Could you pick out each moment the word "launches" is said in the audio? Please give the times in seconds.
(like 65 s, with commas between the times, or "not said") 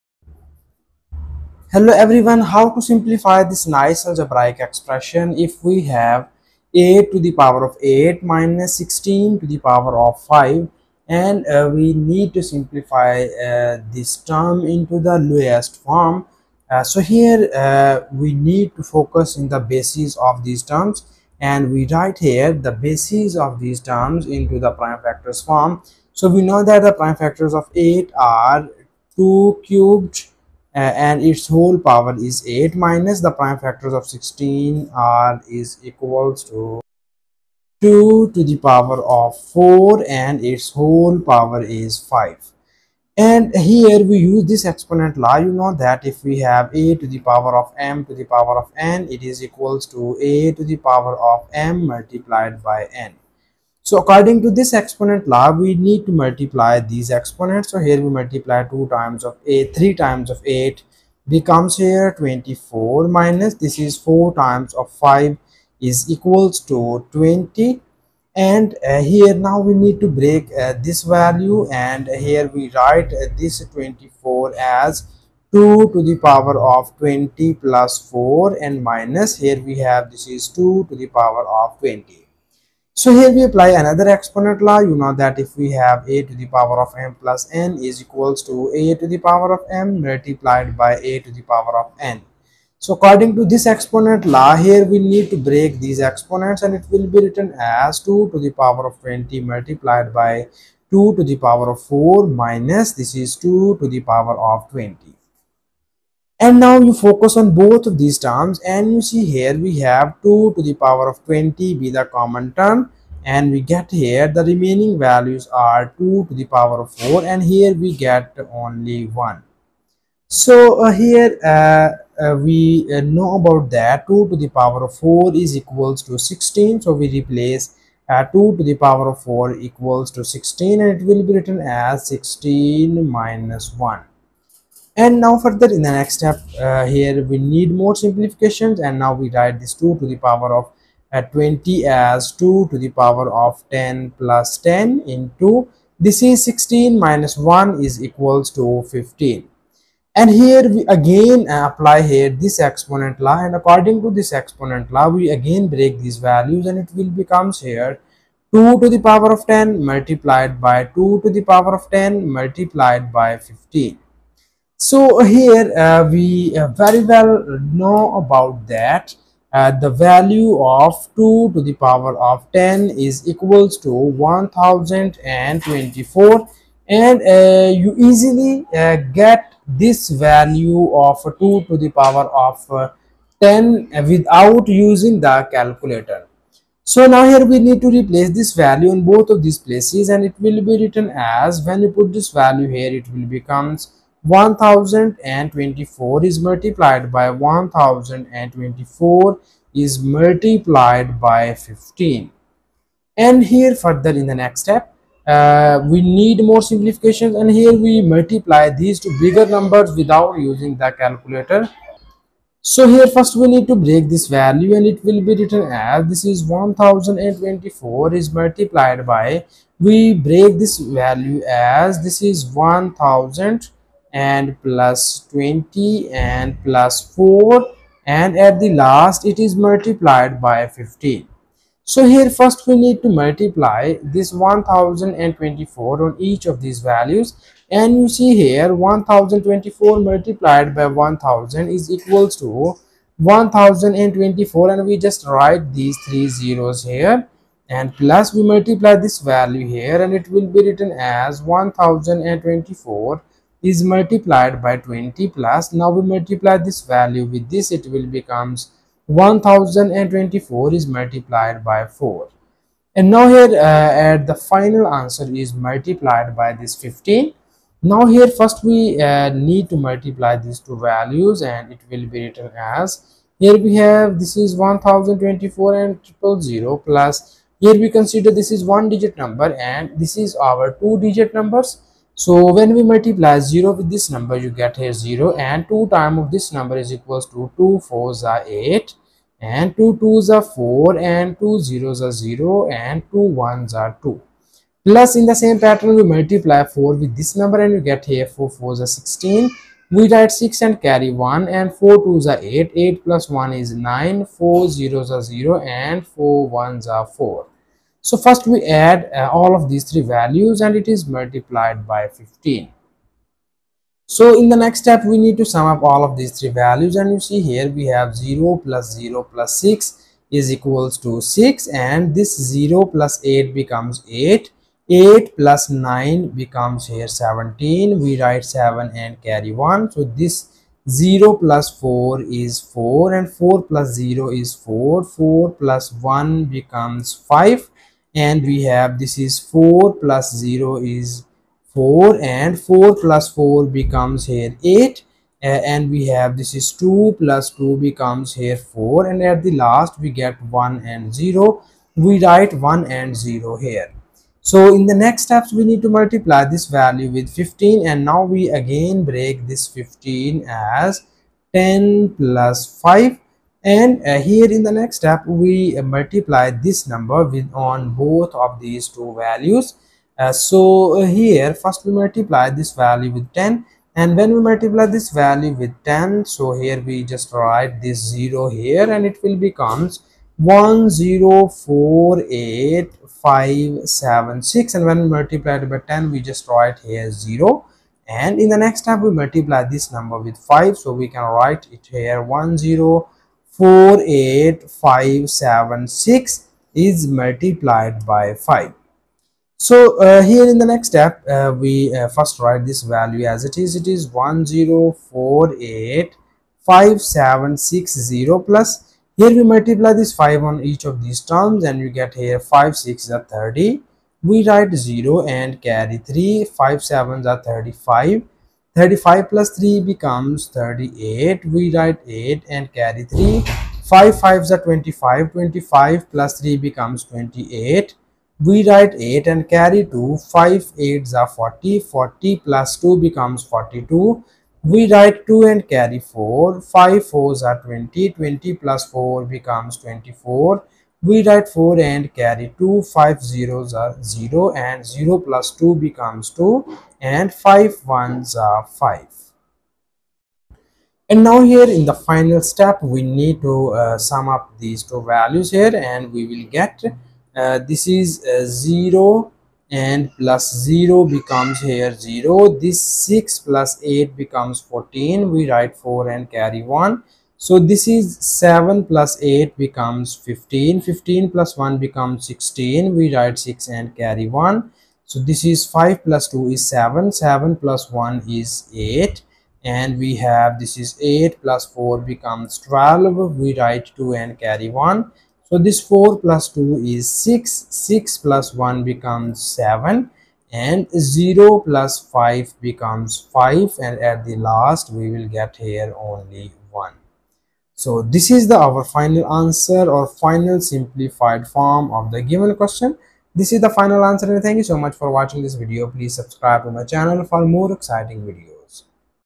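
not said.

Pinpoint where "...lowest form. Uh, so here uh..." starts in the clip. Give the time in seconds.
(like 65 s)
15 s.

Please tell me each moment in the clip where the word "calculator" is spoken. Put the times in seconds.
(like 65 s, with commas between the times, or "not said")
185 s, 210 s.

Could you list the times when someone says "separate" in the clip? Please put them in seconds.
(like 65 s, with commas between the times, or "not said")
not said.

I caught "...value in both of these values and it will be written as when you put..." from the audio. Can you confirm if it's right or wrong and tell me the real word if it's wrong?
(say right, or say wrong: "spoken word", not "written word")
wrong: "places", not "values".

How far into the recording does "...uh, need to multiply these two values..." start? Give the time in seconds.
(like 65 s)
269 s.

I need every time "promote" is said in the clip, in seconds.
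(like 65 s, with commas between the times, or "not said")
not said.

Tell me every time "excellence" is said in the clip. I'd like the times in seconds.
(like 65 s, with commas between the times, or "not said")
not said.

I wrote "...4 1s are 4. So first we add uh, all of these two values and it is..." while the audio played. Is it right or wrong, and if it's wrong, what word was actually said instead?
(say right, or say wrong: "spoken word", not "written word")
wrong: "three", not "two".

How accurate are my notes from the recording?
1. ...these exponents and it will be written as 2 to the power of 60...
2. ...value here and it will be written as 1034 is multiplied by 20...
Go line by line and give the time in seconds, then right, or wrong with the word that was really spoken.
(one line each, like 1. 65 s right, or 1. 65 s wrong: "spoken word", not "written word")
1. 95 s wrong: "20", not "60"
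2. 249 s wrong: "1024", not "1034".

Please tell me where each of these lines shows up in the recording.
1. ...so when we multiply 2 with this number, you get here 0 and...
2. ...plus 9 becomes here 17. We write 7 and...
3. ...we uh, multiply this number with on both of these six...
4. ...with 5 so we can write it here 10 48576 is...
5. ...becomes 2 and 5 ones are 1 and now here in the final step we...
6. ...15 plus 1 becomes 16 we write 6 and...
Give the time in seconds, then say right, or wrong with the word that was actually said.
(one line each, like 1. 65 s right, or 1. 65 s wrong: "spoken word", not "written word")
1. 282 s wrong: "0", not "2"
2. 325 s right
3. 365 s wrong: "two", not "six"
4. 390 s right
5. 445 s wrong: "5", not "1"
6. 470 s right.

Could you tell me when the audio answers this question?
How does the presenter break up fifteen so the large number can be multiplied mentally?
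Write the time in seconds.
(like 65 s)
361 s.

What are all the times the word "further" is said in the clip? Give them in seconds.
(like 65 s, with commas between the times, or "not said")
135 s, 203 s.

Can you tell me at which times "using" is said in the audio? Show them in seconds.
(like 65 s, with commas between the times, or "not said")
184 s, 210 s.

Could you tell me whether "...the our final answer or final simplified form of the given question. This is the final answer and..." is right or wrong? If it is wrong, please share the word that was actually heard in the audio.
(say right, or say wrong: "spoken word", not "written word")
right.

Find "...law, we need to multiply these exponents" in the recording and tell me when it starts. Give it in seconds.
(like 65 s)
55 s.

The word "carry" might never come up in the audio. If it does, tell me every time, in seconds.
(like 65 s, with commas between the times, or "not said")
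300 s, 329 s, 415 s, 442 s, 466 s, 473 s, 484 s.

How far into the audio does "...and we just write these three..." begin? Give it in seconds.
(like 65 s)
244 s.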